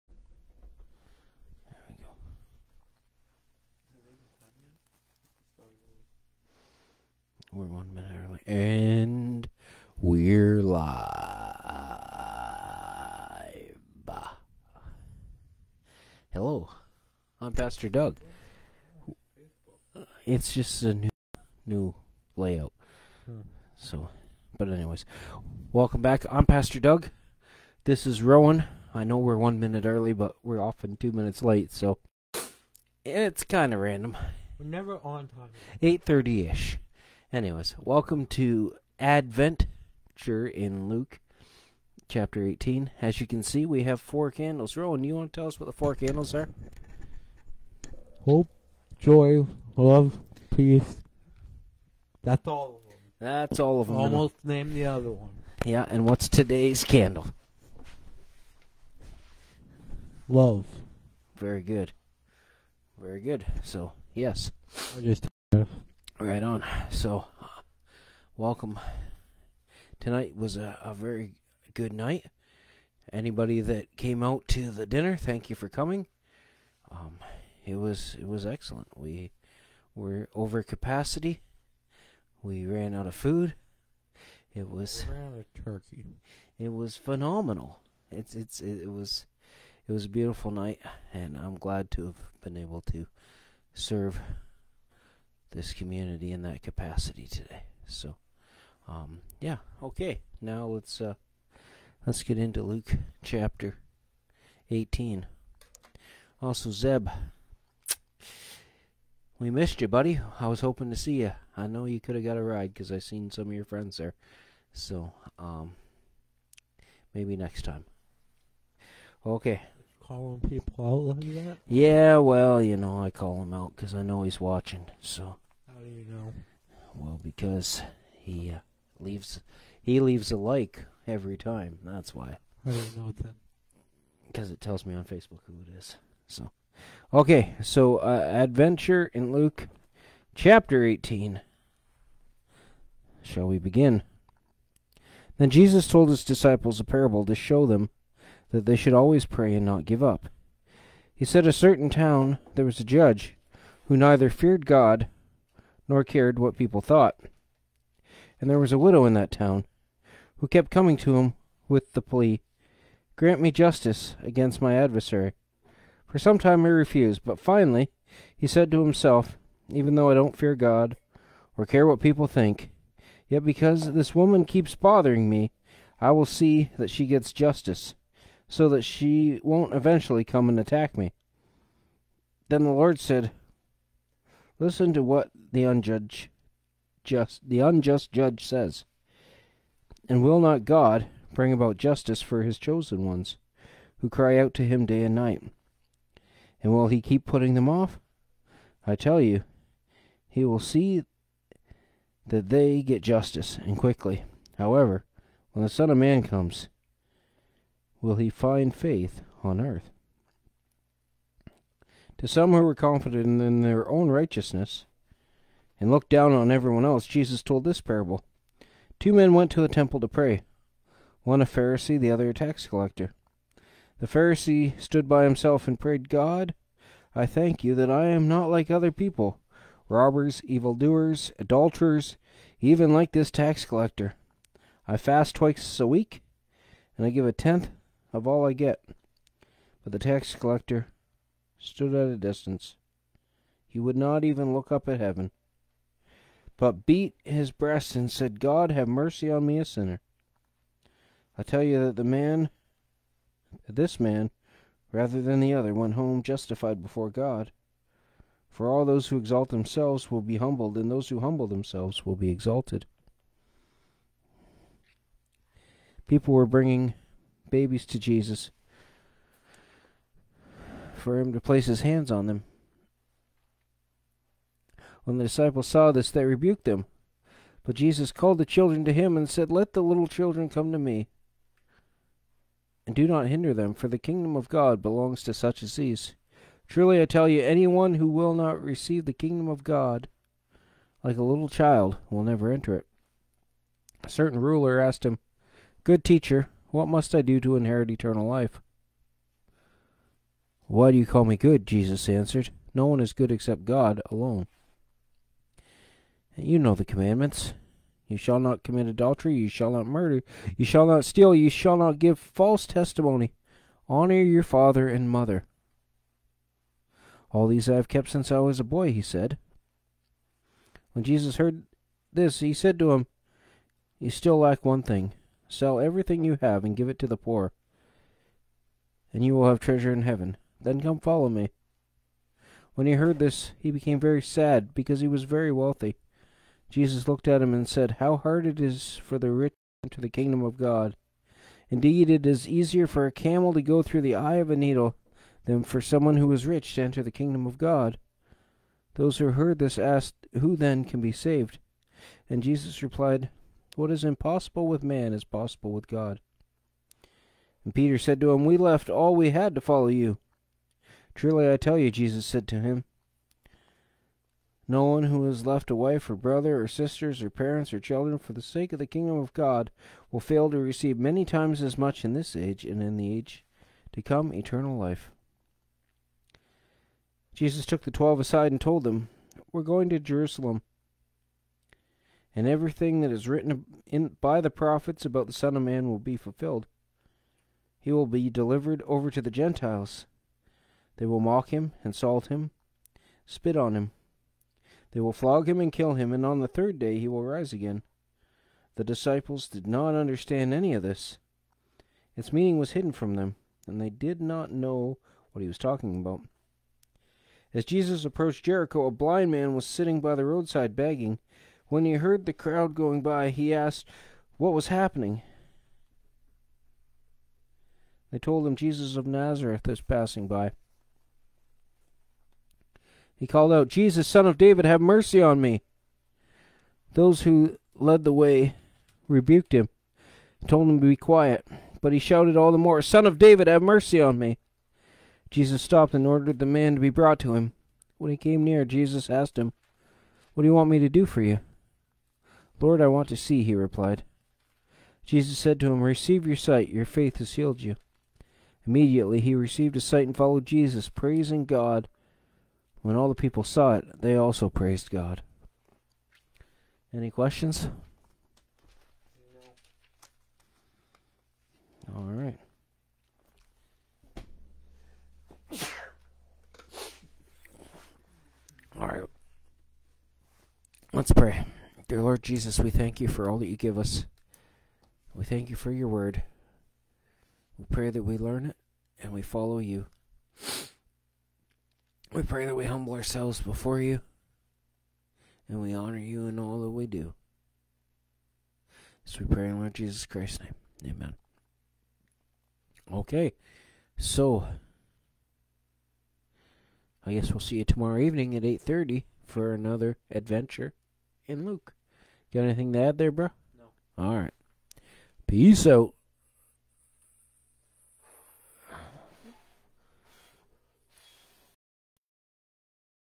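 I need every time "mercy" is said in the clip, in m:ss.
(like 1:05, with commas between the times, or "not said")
4:08, 7:04, 7:13.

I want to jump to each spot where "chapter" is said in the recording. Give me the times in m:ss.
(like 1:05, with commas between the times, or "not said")
0:42, 1:43, 2:20.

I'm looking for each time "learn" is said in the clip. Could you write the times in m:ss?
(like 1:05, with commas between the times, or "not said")
7:58.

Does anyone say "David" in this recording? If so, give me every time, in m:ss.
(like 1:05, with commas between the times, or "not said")
7:04, 7:13.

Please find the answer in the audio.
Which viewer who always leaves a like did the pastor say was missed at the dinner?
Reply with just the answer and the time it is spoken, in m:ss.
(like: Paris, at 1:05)
Zeb, at 1:46.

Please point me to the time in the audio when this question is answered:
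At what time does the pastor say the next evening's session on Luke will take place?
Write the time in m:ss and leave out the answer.
8:18.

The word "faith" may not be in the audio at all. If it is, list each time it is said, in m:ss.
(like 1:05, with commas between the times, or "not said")
3:28, 7:26.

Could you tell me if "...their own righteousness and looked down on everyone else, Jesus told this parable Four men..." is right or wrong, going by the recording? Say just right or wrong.
wrong.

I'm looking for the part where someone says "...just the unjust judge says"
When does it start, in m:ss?
3:07.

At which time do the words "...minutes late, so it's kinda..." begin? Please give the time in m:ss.
0:31.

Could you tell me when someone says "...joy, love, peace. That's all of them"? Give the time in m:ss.
0:48.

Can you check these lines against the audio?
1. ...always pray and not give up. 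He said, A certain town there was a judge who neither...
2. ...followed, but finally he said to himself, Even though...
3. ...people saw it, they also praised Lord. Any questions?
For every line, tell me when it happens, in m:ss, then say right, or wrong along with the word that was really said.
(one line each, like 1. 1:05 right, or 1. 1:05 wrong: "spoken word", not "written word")
1. 2:28 right
2. 2:46 wrong: "refused", not "followed"
3. 7:33 wrong: "God", not "Lord".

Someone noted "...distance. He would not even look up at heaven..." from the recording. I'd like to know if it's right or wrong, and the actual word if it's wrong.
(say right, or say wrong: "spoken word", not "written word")
right.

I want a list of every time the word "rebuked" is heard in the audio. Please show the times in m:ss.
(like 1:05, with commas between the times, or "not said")
4:36, 7:09.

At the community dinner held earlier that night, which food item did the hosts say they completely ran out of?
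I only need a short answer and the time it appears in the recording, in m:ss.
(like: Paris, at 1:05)
Turkey, at 1:25.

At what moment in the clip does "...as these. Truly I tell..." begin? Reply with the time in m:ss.
4:45.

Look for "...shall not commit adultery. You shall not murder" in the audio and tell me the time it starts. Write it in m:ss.
5:08.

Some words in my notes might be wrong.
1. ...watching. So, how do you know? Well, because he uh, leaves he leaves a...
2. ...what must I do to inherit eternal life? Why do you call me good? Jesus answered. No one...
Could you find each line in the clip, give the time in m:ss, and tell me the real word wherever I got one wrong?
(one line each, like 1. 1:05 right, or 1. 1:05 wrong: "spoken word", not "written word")
1. 2:04 right
2. 4:56 right.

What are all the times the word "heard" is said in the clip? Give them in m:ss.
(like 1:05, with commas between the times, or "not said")
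5:21, 5:32, 5:49, 6:51.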